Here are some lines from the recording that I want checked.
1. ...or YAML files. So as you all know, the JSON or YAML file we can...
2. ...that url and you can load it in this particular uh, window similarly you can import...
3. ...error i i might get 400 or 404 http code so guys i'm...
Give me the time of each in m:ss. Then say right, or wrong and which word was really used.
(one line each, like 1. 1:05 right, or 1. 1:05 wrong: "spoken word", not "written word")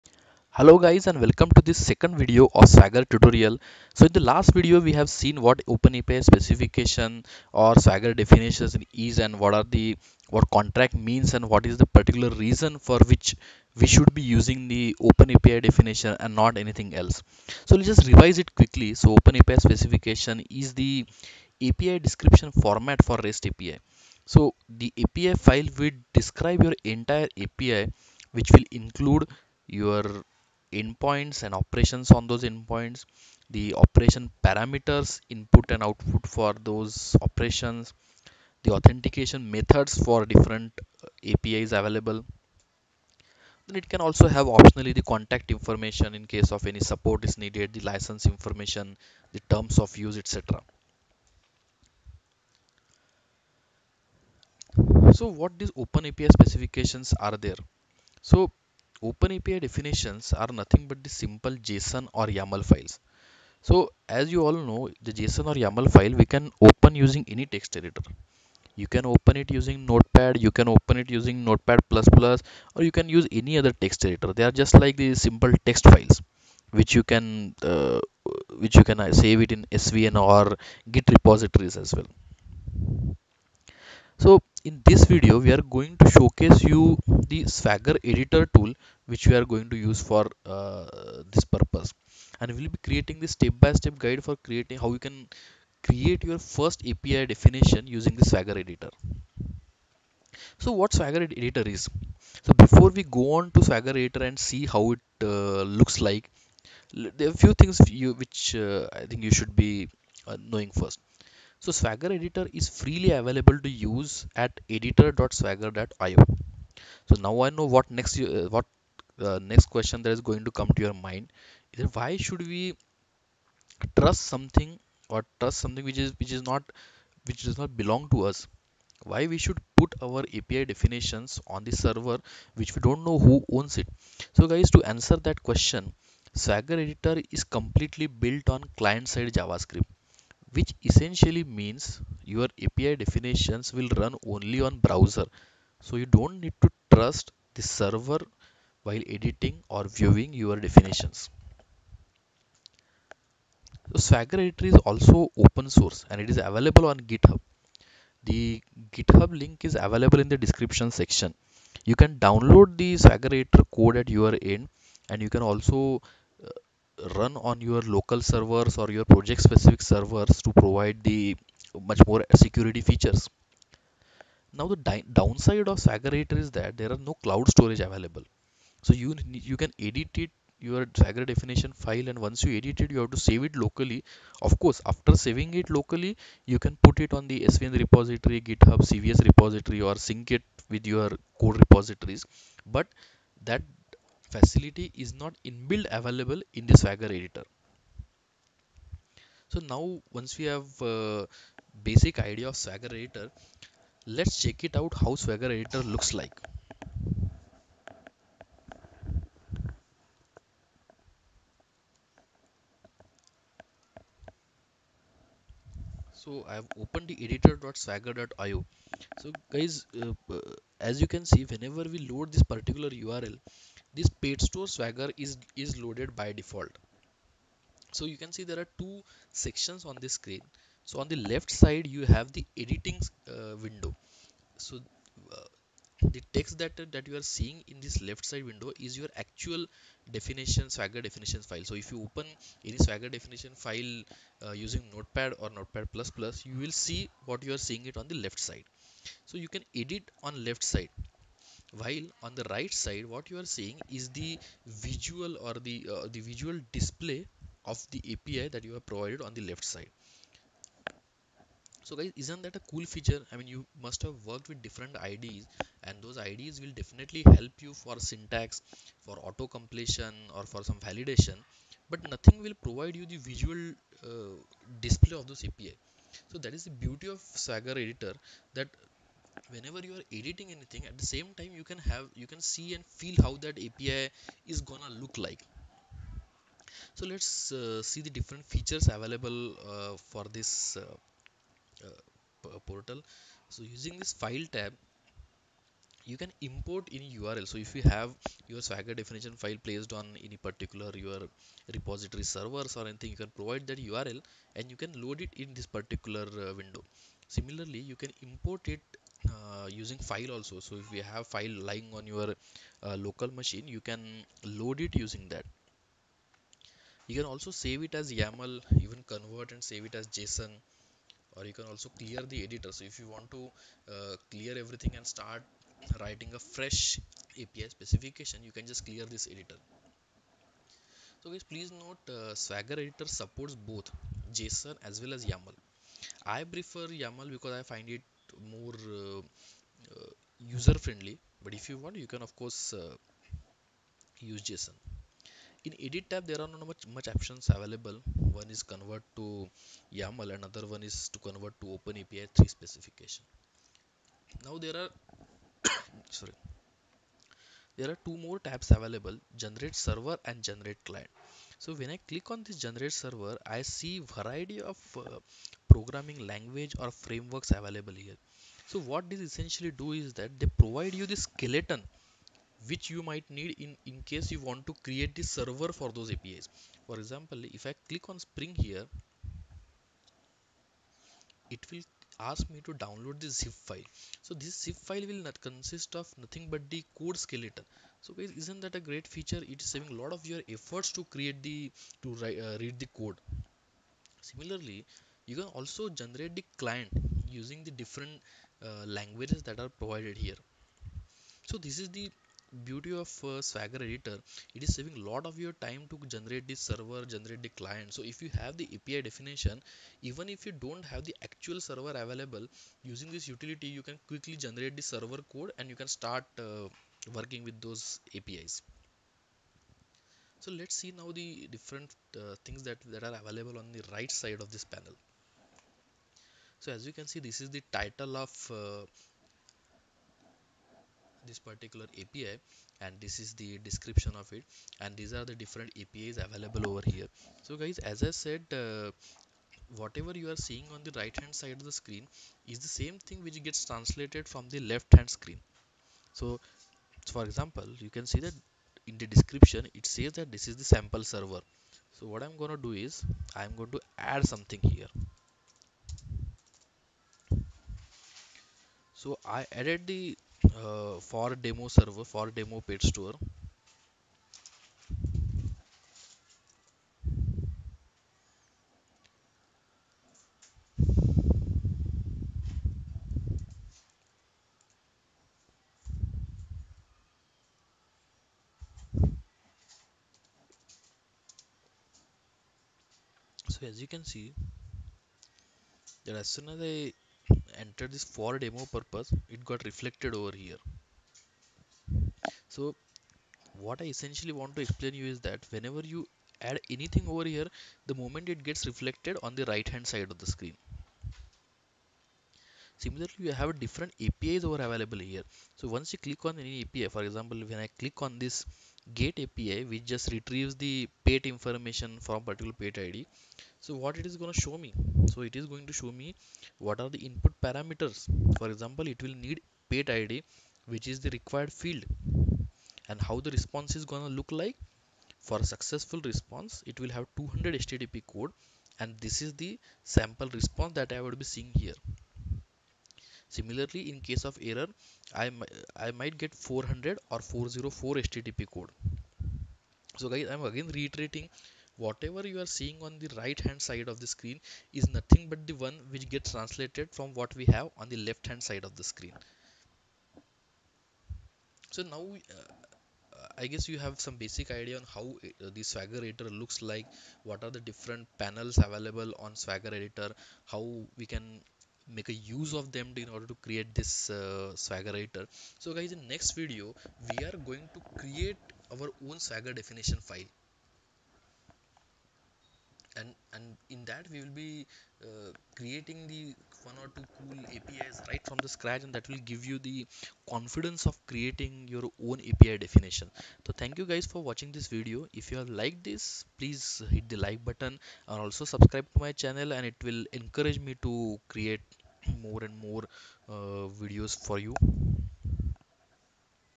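1. 1:02 right
2. 5:03 right
3. 8:54 right.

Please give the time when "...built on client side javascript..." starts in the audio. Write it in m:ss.
2:18.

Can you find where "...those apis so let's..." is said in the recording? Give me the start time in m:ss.
6:57.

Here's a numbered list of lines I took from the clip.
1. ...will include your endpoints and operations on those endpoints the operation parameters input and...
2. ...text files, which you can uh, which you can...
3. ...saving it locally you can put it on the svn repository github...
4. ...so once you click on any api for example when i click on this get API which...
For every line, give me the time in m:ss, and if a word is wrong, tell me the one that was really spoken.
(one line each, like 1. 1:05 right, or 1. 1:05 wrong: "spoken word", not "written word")
1. 0:28 right
2. 1:15 right
3. 3:05 right
4. 8:25 right.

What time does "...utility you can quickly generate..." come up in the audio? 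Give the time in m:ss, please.
6:53.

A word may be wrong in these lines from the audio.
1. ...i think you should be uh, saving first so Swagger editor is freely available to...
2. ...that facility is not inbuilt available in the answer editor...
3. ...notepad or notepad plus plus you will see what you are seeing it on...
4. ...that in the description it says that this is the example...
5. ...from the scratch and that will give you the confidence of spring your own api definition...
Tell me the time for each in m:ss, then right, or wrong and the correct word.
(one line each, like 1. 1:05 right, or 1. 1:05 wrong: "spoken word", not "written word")
1. 1:49 wrong: "knowing", not "saving"
2. 3:13 wrong: "swagger", not "answer"
3. 4:04 right
4. 7:28 wrong: "sample", not "example"
5. 9:38 wrong: "creating", not "spring".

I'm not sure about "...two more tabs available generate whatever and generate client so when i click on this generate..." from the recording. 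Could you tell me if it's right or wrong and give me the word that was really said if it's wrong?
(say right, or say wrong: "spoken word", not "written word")
wrong: "server", not "whatever".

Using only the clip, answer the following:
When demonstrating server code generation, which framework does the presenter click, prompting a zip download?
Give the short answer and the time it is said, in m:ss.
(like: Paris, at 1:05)
Spring, at 6:18.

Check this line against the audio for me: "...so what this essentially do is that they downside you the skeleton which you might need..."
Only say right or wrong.
wrong.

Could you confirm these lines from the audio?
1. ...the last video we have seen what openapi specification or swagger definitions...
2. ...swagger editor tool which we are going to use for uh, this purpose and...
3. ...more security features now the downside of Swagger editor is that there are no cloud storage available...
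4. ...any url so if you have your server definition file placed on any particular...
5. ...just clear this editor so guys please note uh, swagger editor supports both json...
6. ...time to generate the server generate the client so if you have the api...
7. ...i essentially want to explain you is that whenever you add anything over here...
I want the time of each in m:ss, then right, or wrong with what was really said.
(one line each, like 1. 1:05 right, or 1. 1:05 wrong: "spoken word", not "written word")
1. 0:04 right
2. 1:27 right
3. 2:52 right
4. 4:56 wrong: "swagger", not "server"
5. 5:28 right
6. 6:45 right
7. 8:13 right.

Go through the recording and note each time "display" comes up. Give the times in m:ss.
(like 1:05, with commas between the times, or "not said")
4:16, 4:34.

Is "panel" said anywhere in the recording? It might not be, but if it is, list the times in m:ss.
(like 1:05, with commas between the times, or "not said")
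7:04, 9:18.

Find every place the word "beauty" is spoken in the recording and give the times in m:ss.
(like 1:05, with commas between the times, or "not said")
4:36, 6:42.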